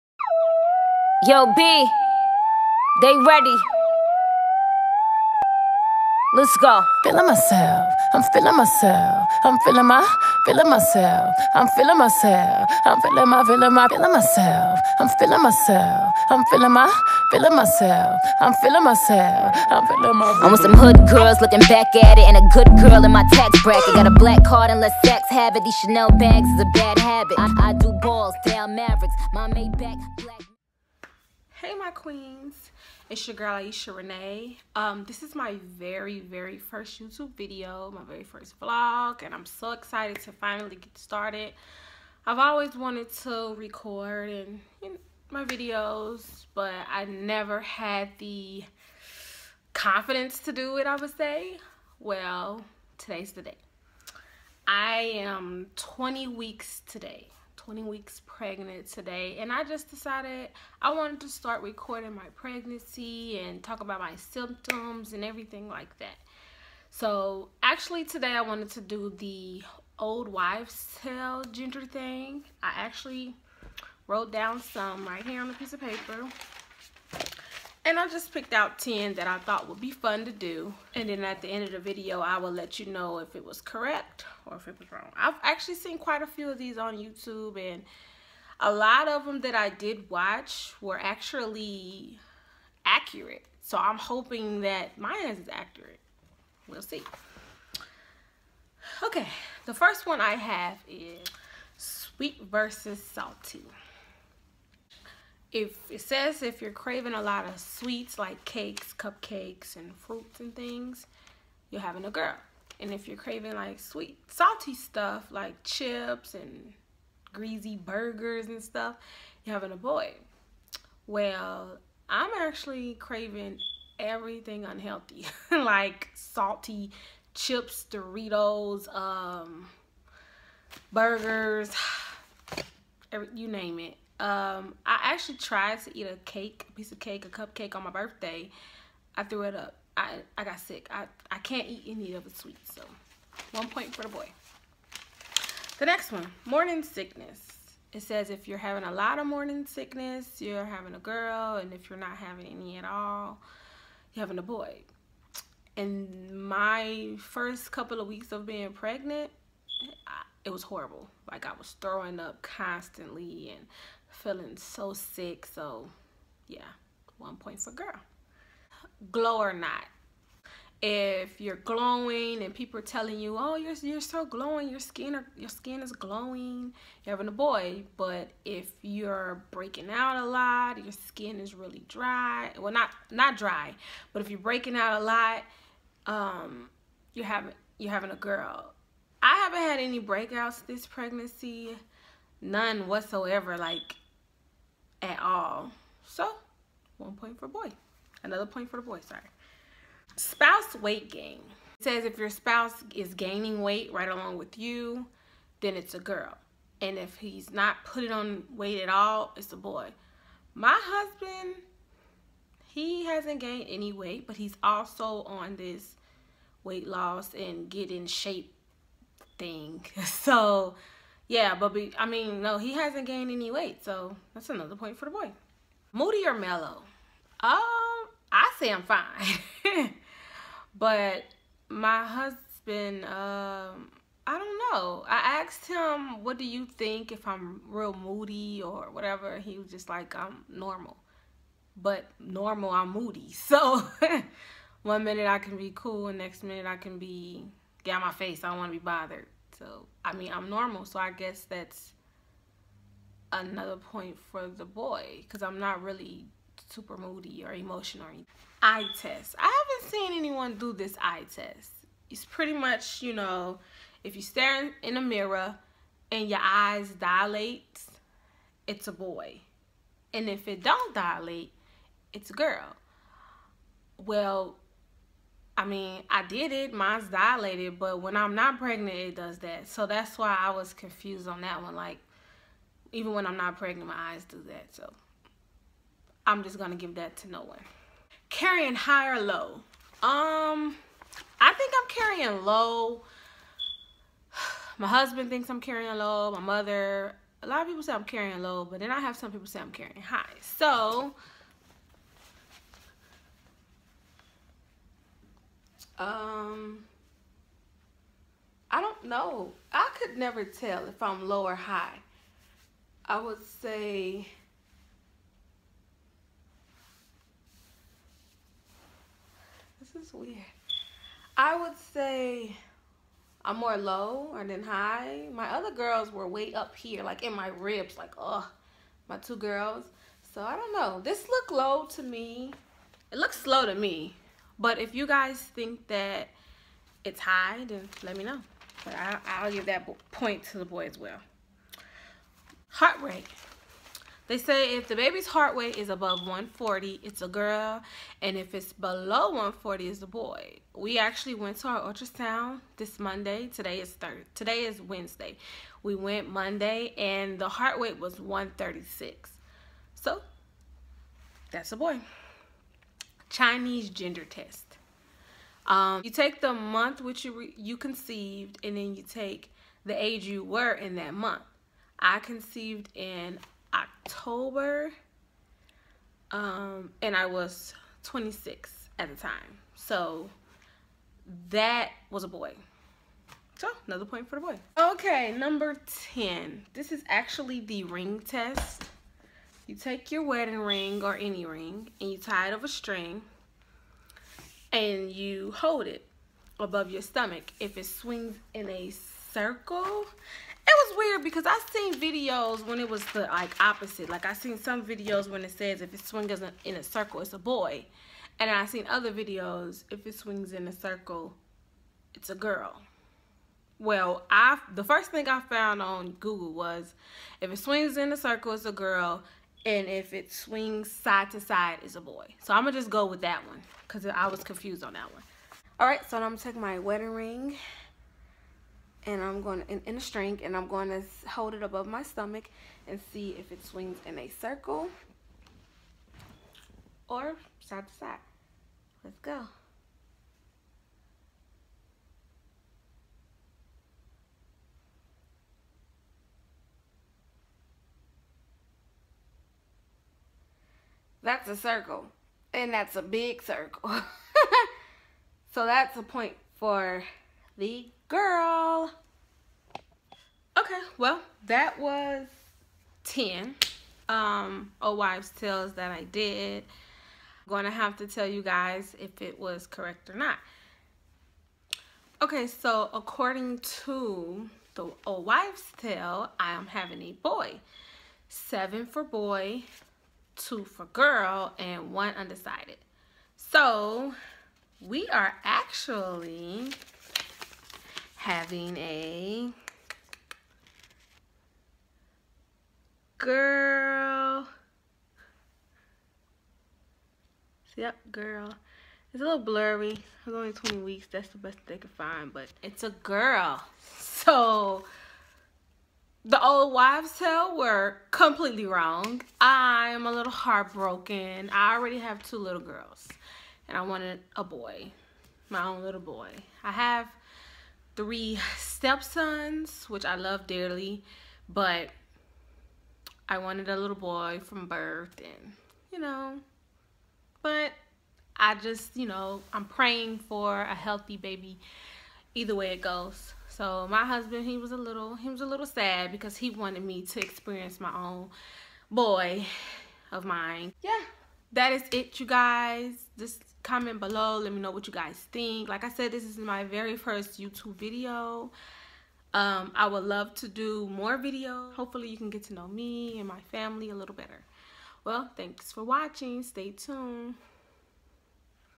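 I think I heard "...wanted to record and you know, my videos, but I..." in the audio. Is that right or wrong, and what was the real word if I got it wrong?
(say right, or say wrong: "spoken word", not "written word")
right.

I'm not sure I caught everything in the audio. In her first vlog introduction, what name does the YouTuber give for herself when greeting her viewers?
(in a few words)
Ieisha Renee.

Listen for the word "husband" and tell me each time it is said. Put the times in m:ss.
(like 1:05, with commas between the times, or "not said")
3:30, 3:52, 4:54, 8:54.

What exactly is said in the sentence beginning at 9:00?
Yeah, that is it, you guys.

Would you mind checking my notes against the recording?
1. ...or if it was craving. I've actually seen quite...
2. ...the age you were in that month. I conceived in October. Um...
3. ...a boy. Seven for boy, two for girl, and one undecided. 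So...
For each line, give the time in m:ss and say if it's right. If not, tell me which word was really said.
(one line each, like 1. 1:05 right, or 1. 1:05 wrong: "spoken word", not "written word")
1. 1:24 wrong: "wrong", not "craving"
2. 6:09 right
3. 7:57 right.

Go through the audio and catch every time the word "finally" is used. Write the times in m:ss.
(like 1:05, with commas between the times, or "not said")
0:40.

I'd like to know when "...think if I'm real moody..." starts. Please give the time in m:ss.
3:56.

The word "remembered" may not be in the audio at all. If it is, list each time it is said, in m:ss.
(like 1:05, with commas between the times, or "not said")
not said.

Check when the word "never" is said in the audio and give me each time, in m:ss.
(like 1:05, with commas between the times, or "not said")
0:47, 5:10.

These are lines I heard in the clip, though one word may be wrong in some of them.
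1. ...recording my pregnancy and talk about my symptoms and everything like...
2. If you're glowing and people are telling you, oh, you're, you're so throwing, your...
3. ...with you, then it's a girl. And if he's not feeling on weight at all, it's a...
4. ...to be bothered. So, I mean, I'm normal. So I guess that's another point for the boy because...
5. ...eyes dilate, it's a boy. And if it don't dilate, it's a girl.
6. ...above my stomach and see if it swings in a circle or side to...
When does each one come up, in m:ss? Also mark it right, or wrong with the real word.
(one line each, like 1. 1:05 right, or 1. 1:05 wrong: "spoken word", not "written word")
1. 1:01 right
2. 2:50 wrong: "glowing", not "throwing"
3. 3:24 wrong: "putting", not "feeling"
4. 4:08 right
5. 4:26 right
6. 7:11 right.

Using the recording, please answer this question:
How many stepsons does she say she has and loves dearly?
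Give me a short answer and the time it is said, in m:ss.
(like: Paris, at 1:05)
3, at 8:38.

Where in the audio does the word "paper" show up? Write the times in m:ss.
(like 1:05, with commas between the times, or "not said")
1:15.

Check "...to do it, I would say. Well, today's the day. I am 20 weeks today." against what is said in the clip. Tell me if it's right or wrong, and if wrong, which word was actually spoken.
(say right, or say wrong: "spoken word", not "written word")
right.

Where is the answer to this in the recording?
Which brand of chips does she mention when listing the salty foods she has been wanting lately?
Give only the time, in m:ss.
2:07.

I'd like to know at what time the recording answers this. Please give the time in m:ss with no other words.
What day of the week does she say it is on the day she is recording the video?
5:54.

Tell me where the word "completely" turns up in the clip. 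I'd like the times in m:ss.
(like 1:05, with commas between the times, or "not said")
8:28.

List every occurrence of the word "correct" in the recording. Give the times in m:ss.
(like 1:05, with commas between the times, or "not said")
1:23, 7:49.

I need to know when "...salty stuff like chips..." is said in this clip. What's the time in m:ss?
1:54.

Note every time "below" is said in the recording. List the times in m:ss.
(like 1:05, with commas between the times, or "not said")
5:48, 9:03.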